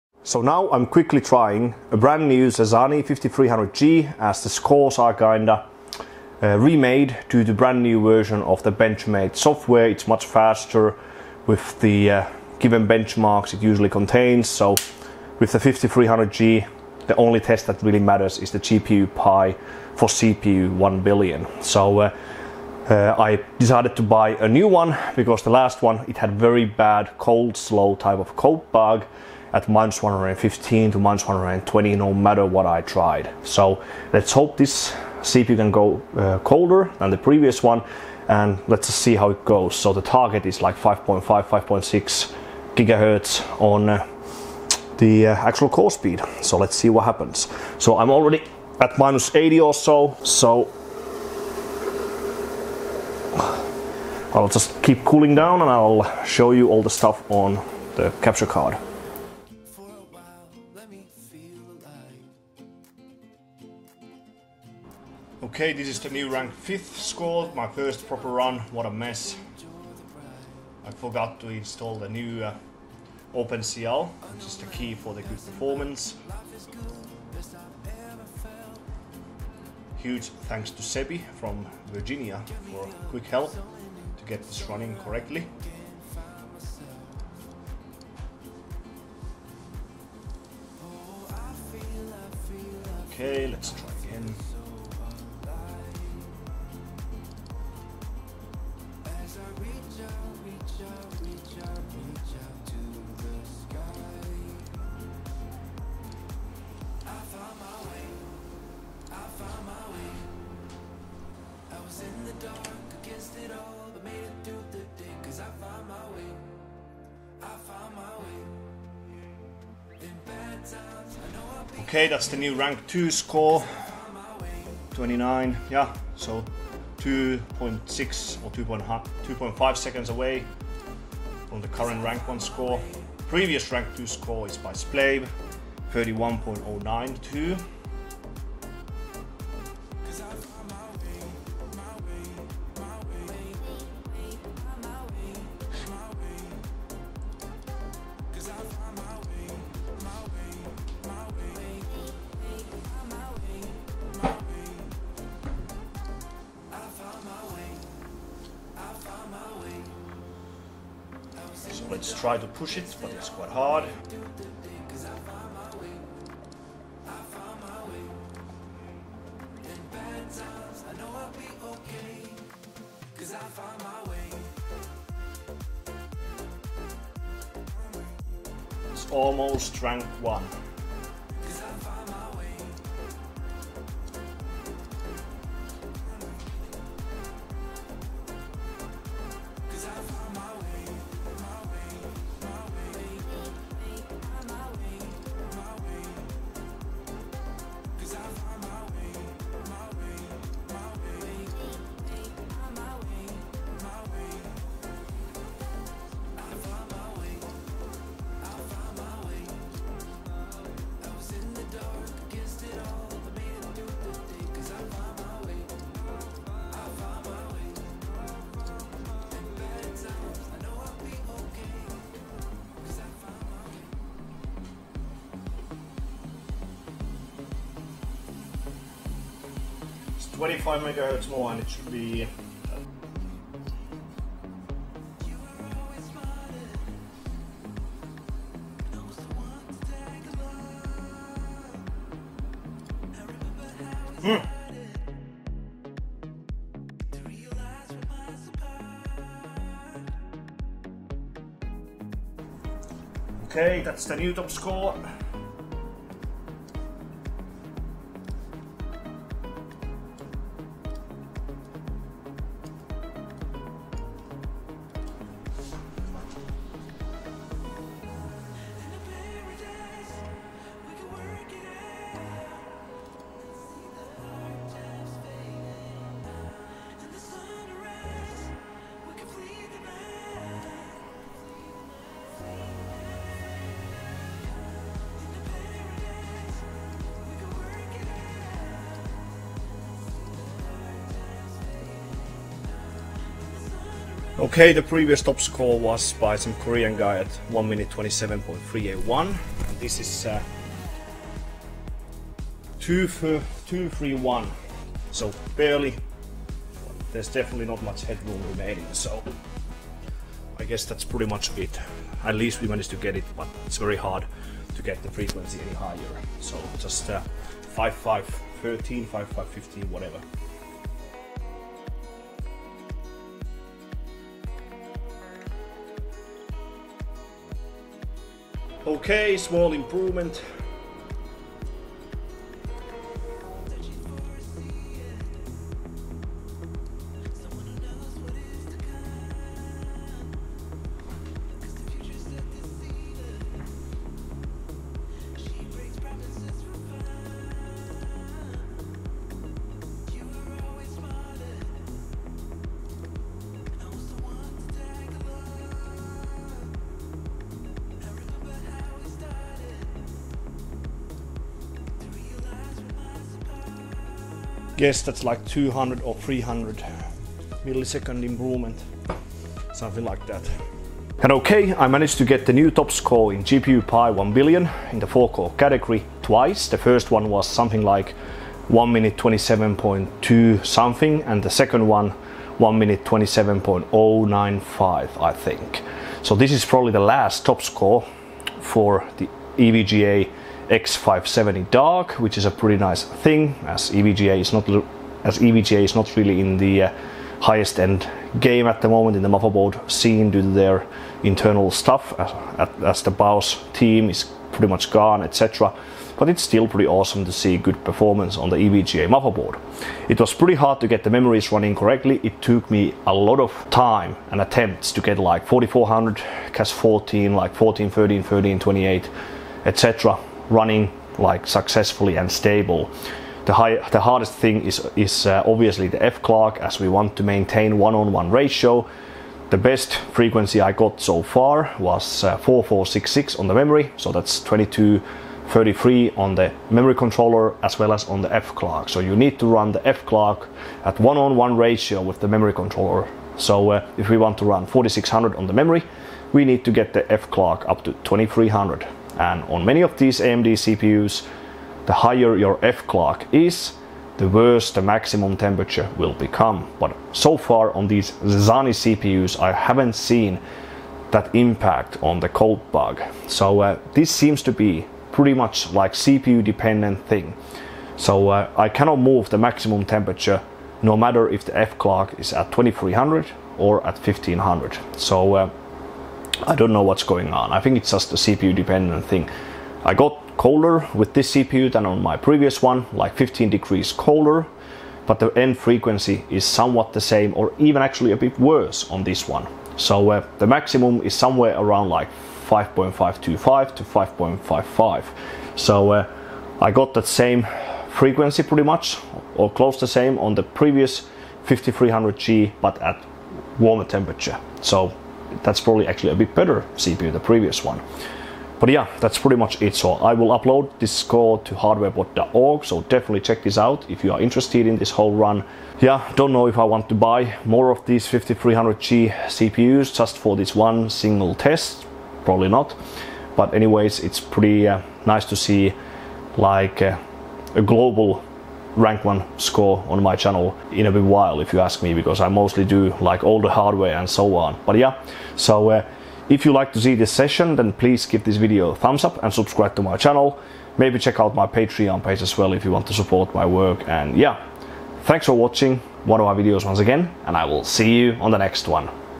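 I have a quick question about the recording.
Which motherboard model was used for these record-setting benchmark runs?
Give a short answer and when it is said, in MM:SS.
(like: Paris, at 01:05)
EVGA X570 Dark, at 06:29.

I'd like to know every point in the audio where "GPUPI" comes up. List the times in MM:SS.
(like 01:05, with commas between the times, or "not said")
00:18, 06:13.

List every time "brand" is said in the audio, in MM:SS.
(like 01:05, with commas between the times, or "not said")
00:01, 00:07.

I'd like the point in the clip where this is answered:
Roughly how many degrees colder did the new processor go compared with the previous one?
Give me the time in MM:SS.
08:03.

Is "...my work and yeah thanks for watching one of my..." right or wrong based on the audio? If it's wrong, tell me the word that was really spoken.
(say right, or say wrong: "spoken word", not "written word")
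right.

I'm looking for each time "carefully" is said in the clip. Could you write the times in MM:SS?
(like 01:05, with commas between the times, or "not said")
not said.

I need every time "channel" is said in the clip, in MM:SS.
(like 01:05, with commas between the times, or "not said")
08:50, 08:59.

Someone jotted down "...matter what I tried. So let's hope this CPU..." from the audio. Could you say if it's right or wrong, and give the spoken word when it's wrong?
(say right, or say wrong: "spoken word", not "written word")
right.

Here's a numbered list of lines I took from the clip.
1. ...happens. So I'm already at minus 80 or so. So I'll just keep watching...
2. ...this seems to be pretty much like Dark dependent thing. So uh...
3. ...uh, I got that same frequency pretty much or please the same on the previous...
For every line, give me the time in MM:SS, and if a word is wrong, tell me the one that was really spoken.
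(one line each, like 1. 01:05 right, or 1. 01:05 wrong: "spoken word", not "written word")
1. 00:47 wrong: "cooling", not "watching"
2. 07:43 wrong: "CPU", not "Dark"
3. 08:15 wrong: "close", not "please".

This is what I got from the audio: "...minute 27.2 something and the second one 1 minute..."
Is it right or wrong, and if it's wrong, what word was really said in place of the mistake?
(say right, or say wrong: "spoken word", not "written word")
right.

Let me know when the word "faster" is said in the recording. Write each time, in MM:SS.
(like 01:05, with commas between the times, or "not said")
00:10.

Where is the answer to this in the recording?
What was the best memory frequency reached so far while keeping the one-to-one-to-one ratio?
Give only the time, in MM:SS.
07:12.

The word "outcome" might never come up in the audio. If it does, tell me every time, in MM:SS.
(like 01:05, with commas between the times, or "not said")
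not said.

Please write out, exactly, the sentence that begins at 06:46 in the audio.
But it's still pretty awesome to see good performance on the EVGA motherboard.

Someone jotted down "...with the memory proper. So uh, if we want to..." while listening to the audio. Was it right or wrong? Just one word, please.
wrong.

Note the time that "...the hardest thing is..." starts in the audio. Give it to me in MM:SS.
07:03.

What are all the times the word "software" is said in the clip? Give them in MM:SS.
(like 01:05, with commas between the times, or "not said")
00:09.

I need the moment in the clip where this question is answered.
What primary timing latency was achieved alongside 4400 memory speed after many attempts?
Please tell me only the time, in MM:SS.
06:56.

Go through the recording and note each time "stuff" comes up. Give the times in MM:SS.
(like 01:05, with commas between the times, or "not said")
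00:56, 06:41.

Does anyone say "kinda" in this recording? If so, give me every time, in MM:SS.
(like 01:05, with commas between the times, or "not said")
00:05.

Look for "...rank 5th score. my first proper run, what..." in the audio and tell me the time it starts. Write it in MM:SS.
01:06.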